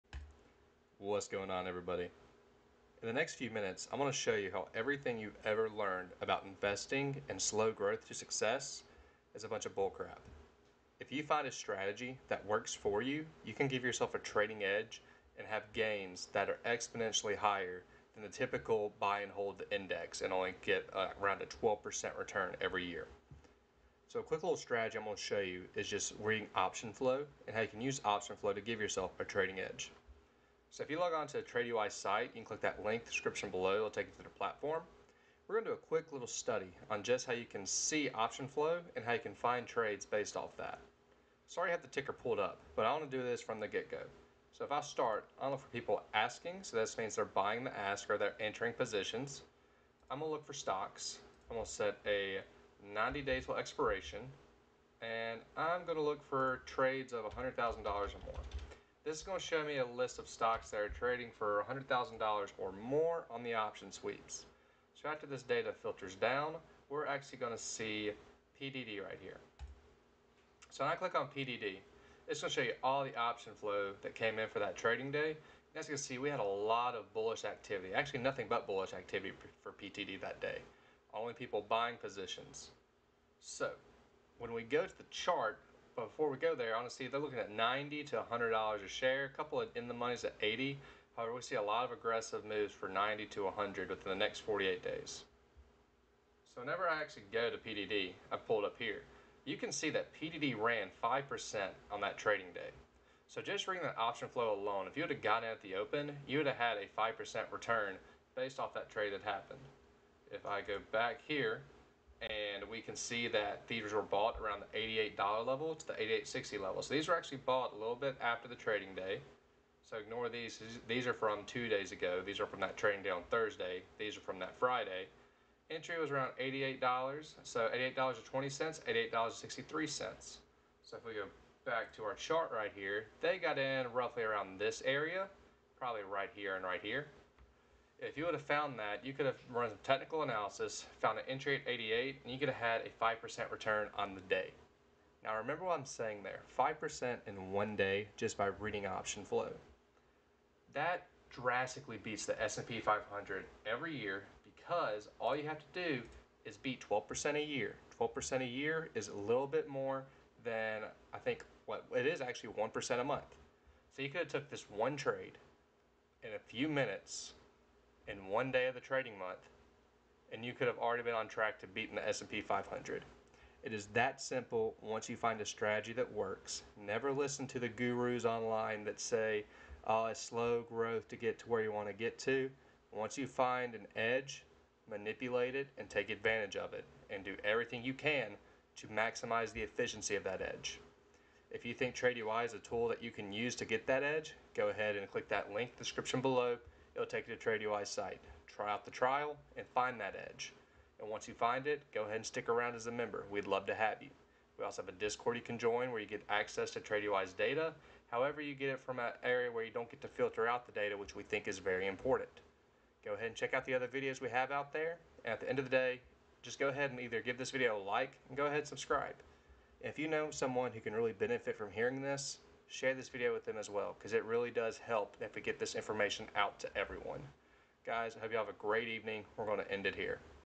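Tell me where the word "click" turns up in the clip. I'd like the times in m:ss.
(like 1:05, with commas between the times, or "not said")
0:32, 1:10, 3:15.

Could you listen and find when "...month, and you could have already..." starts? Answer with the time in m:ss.
2:49.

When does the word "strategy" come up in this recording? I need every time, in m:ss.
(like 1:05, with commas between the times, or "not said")
0:11, 0:24, 2:55.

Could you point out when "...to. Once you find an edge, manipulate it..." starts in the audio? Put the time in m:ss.
3:02.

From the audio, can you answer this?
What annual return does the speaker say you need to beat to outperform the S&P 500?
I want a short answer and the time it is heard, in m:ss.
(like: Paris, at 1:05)
12%, at 2:35.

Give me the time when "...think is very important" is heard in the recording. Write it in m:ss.
3:31.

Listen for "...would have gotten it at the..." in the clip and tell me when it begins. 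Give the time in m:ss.
1:45.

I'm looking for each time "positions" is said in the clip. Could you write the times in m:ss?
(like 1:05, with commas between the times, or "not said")
0:48, 1:21.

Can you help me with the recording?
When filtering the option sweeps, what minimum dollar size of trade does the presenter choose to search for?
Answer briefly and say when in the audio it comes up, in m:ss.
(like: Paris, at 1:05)
$100,000, at 0:57.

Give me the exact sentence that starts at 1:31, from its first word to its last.
However, we see a lot of aggressive moves for 90 to 100 within the next 48 days.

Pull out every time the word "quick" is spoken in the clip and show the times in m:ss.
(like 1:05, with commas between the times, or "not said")
0:24, 0:35.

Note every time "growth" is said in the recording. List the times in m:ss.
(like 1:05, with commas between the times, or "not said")
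0:07, 3:00.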